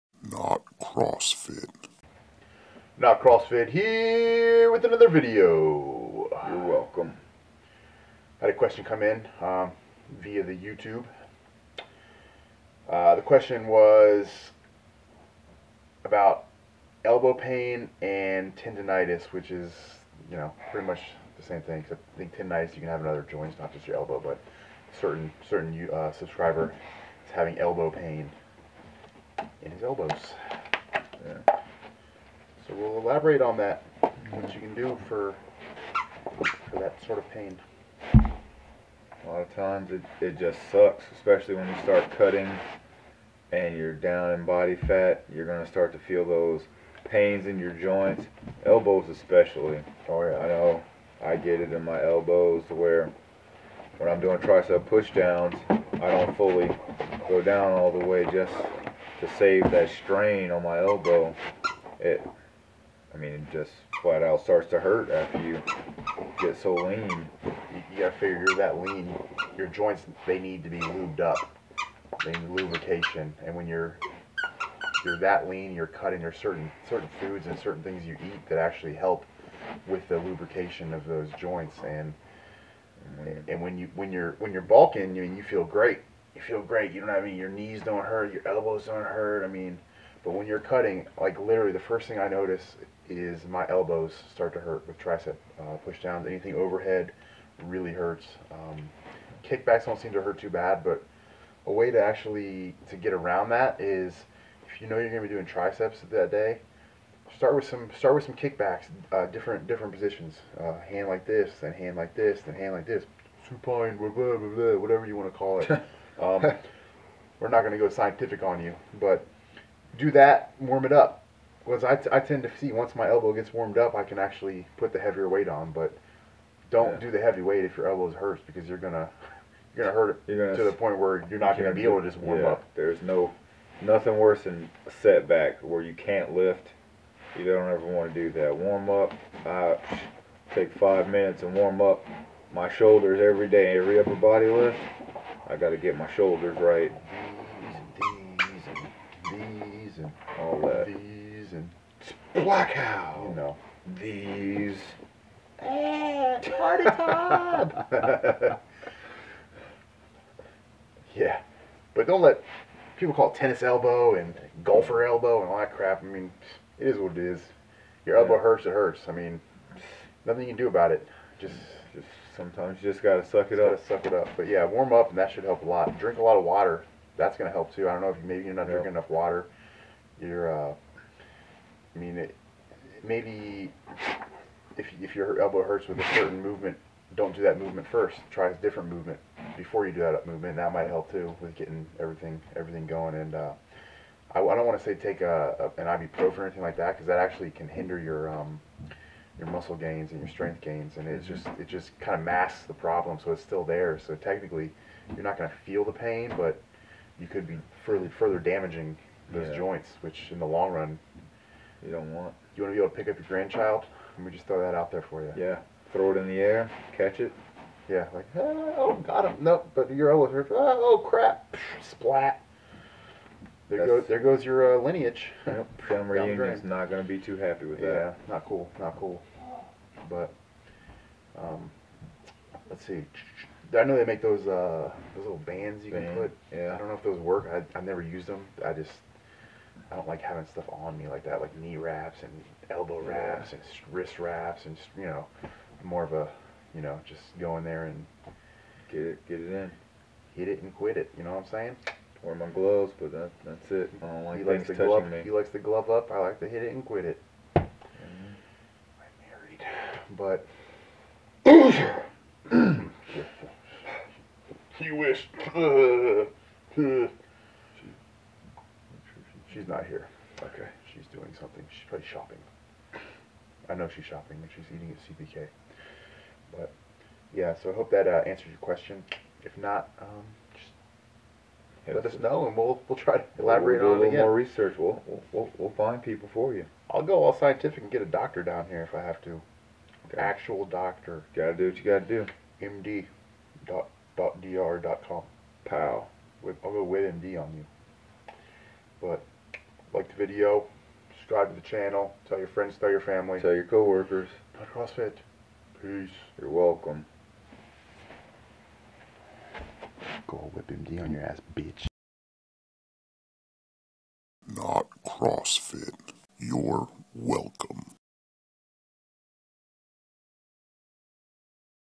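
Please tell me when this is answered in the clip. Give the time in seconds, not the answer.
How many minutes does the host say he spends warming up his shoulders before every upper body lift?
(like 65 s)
140 s.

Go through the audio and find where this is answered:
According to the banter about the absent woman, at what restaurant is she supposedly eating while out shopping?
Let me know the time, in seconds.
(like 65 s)
275 s.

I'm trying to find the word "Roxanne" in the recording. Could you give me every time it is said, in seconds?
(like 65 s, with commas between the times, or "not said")
not said.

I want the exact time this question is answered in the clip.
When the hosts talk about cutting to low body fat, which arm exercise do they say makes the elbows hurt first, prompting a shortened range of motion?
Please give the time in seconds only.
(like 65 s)
54 s.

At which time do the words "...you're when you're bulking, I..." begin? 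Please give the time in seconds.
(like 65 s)
84 s.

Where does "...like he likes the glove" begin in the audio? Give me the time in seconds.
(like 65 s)
254 s.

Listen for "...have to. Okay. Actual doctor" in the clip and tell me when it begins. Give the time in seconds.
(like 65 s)
289 s.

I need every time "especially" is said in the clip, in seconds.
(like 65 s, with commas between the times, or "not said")
41 s, 49 s.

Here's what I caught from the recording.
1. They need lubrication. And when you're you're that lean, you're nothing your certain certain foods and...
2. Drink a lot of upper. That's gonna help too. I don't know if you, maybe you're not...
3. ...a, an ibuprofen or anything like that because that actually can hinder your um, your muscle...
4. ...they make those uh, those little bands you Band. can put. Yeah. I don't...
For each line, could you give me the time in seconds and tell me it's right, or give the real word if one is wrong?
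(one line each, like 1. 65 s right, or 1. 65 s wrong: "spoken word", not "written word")
1. 72 s wrong: "cutting", not "nothing"
2. 175 s wrong: "water", not "upper"
3. 195 s right
4. 233 s right.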